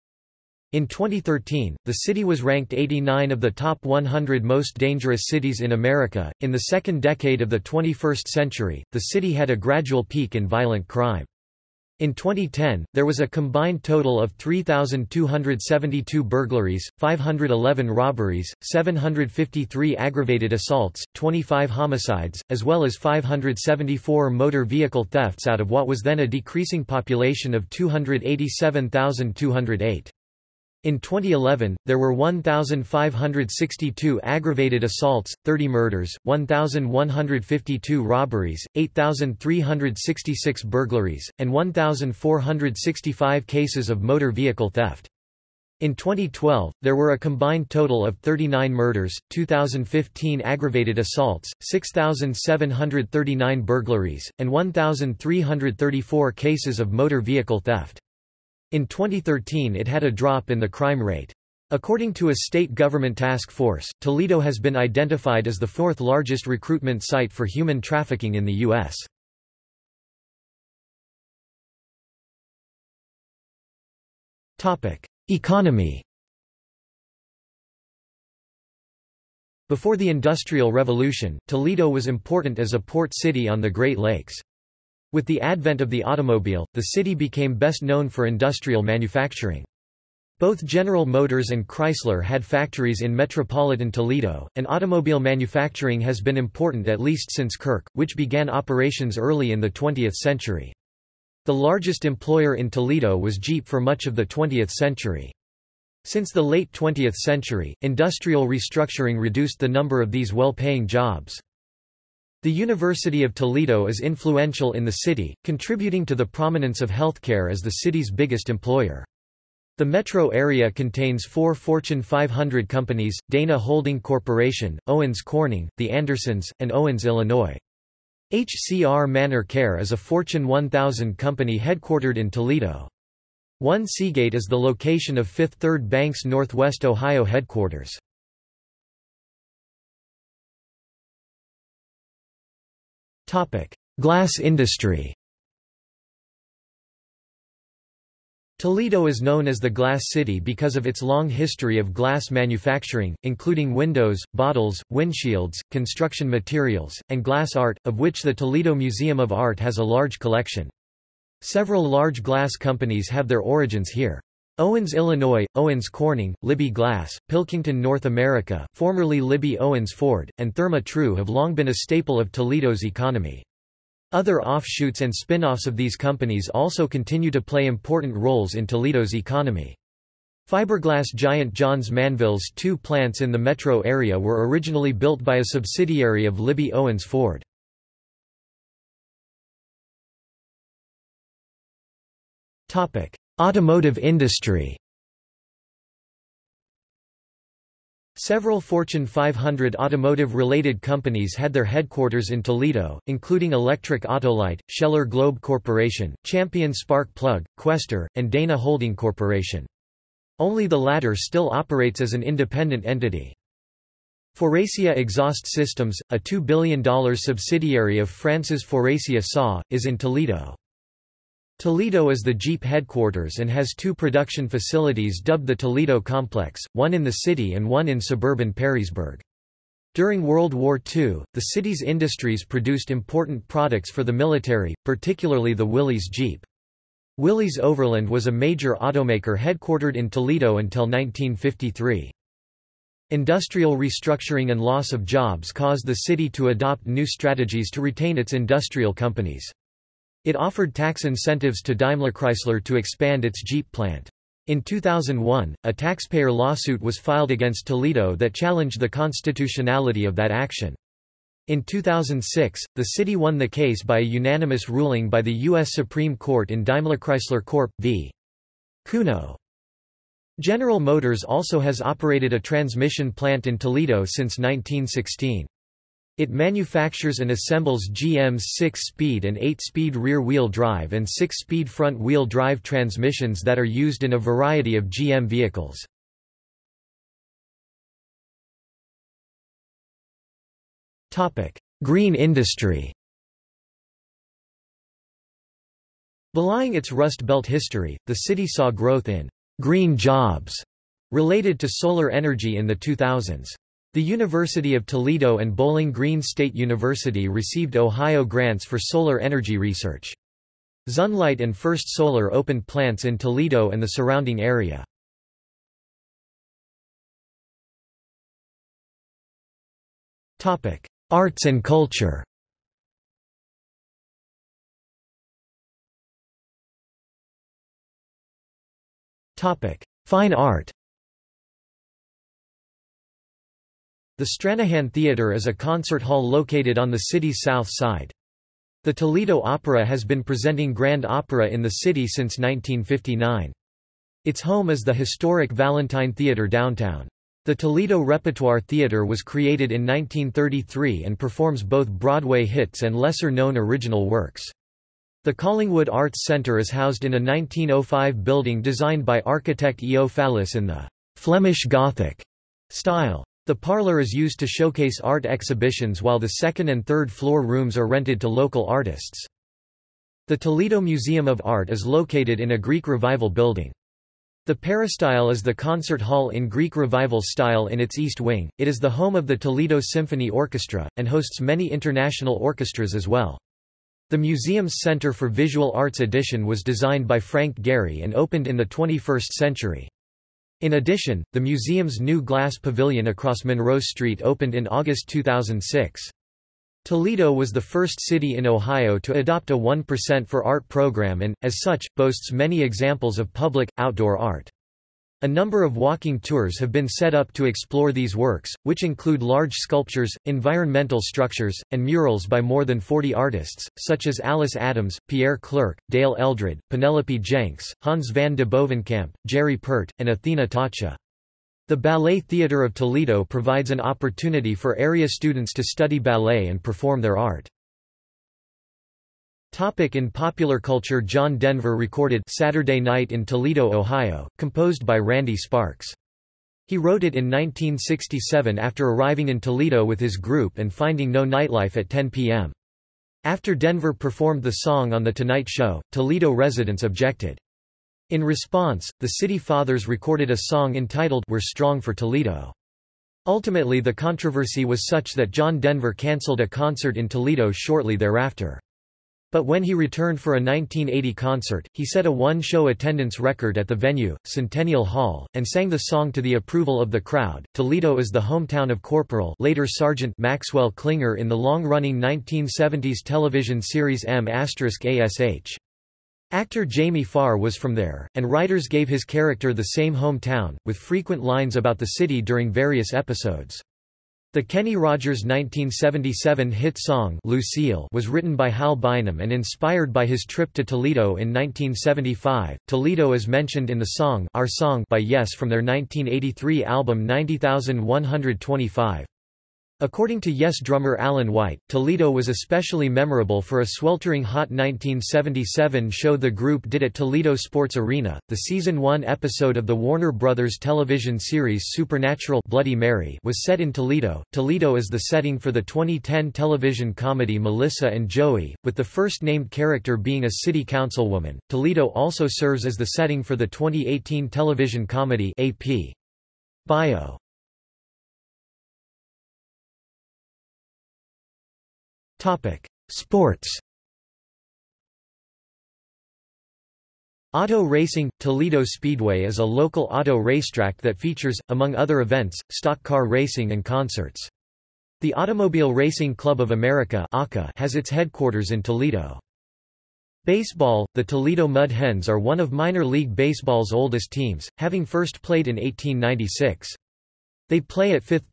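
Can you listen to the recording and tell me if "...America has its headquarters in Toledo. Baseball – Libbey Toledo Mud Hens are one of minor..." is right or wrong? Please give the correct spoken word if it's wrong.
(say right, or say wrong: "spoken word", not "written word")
wrong: "The", not "Libbey".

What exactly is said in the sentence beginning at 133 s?
One Seagate is the location of Fifth Third Bank's Northwest Ohio headquarters.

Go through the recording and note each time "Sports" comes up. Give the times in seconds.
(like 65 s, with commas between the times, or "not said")
507 s, 532 s.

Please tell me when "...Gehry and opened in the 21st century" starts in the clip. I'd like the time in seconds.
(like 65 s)
387 s.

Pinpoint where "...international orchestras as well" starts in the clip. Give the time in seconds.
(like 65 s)
381 s.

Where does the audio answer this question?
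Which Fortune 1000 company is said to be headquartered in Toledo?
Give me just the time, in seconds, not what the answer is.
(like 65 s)
128 s.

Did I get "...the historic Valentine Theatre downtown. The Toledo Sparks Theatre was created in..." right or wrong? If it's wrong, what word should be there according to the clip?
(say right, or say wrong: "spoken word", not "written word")
wrong: "Repertoire", not "Sparks".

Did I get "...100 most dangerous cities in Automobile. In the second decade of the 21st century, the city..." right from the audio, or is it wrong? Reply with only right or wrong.
wrong.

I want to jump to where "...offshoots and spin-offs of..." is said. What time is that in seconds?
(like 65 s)
174 s.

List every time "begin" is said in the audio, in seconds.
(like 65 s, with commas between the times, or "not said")
not said.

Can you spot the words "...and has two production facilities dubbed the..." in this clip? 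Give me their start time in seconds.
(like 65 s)
223 s.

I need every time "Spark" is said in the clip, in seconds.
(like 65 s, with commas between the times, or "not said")
206 s, 435 s.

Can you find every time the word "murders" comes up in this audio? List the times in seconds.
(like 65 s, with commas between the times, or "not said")
35 s, 48 s.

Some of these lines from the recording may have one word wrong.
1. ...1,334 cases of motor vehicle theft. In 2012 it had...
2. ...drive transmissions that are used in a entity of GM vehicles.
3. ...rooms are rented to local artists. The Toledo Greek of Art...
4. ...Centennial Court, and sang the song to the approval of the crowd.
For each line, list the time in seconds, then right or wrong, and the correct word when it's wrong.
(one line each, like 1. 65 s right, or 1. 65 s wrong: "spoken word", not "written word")
1. 54 s wrong: "2013", not "2012"
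2. 282 s wrong: "variety", not "entity"
3. 367 s wrong: "Museum", not "Greek"
4. 464 s wrong: "Hall", not "Court".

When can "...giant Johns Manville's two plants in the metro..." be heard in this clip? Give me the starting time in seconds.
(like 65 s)
181 s.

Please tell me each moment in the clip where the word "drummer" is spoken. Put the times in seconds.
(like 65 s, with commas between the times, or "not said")
500 s.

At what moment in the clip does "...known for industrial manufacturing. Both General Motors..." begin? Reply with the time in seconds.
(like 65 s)
87 s.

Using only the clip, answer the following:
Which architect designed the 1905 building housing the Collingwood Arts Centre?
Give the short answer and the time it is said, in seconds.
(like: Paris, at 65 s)
E. O. Fallis, at 359 s.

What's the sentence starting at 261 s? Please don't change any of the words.
In 2006, the city won the case by a unanimous ruling by the U.S.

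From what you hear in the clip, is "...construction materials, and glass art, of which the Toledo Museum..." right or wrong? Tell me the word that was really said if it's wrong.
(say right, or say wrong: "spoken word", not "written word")
right.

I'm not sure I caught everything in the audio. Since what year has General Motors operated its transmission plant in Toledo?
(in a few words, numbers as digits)
1916.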